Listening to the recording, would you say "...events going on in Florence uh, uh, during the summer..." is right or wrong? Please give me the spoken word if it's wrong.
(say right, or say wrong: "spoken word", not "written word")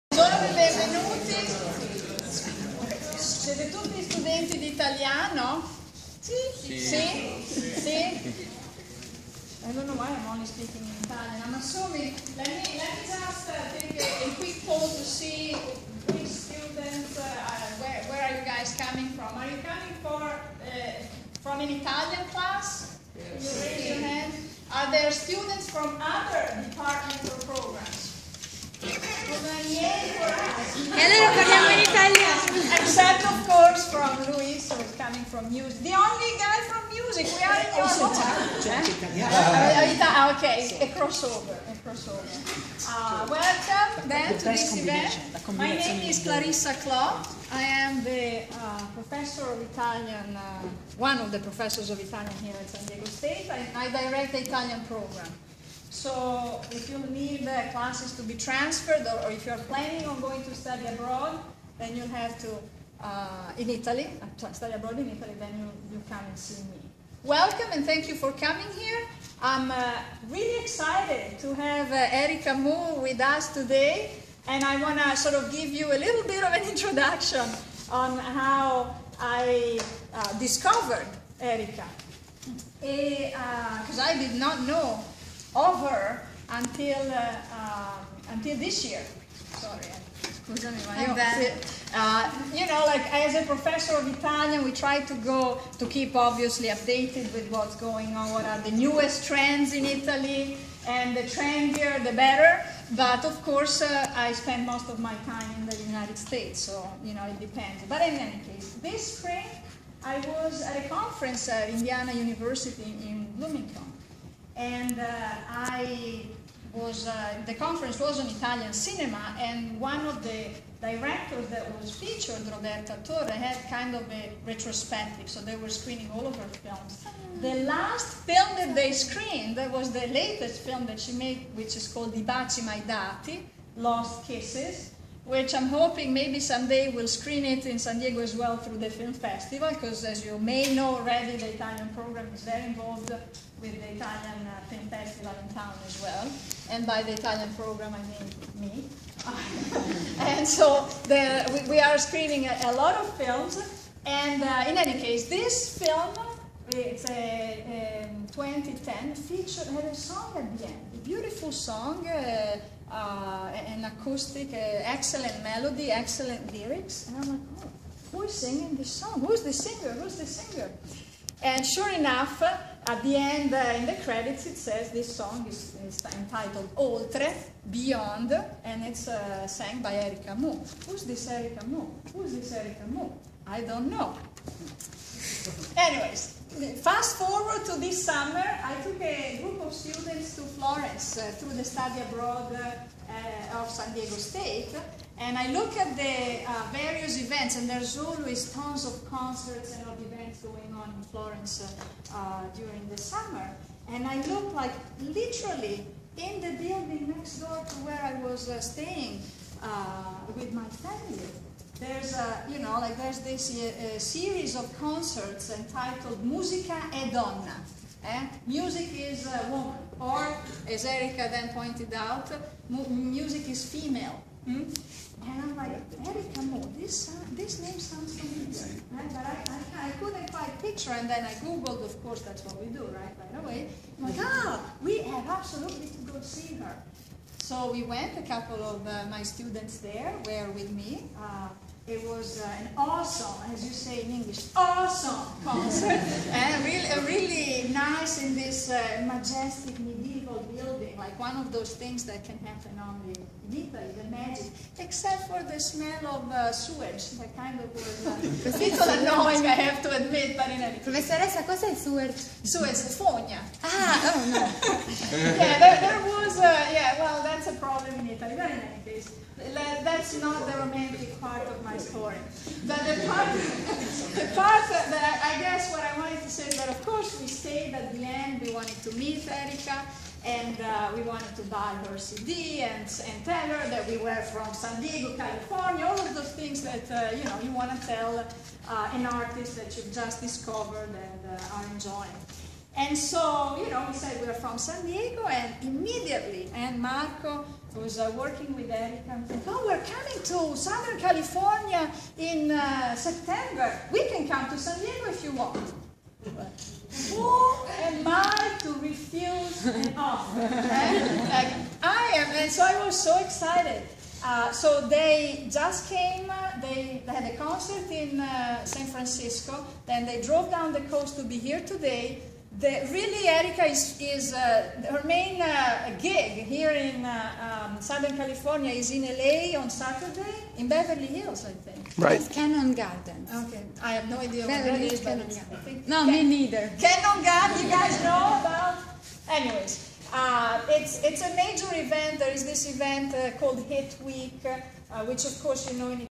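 right.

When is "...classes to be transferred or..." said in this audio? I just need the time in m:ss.
0:57.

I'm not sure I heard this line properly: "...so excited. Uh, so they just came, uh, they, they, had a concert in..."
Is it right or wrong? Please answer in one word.
right.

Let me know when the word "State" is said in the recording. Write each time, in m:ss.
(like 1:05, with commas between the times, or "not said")
0:53, 1:46, 3:14.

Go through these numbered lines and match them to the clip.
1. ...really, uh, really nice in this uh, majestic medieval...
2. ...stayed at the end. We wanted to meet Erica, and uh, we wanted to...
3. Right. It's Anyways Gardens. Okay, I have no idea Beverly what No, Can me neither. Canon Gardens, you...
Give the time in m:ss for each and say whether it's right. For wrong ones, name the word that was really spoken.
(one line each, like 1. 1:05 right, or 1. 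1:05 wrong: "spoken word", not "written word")
1. 4:06 right
2. 4:37 right
3. 5:31 wrong: "Canon", not "Anyways".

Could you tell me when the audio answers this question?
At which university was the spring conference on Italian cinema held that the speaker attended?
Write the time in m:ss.
1:51.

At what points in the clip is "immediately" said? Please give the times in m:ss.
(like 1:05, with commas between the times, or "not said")
4:55.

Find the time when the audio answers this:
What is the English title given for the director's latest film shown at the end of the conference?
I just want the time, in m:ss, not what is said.
2:13.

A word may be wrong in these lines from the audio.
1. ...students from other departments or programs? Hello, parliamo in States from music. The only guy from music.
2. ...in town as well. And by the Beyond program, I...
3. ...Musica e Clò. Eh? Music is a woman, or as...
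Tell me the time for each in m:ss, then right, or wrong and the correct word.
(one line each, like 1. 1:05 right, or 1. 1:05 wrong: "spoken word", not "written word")
1. 0:25 wrong: "Italian", not "States"
2. 2:25 wrong: "Italian", not "Beyond"
3. 3:36 wrong: "Donna", not "Clò".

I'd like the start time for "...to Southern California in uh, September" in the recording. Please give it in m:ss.
5:00.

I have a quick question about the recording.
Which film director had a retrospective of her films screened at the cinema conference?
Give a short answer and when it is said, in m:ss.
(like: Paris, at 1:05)
Roberta Torre, at 2:02.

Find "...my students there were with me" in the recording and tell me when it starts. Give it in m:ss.
3:59.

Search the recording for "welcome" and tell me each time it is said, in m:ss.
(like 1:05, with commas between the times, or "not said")
0:43, 1:07.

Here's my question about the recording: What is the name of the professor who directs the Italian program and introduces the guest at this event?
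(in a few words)
Clarissa Clò.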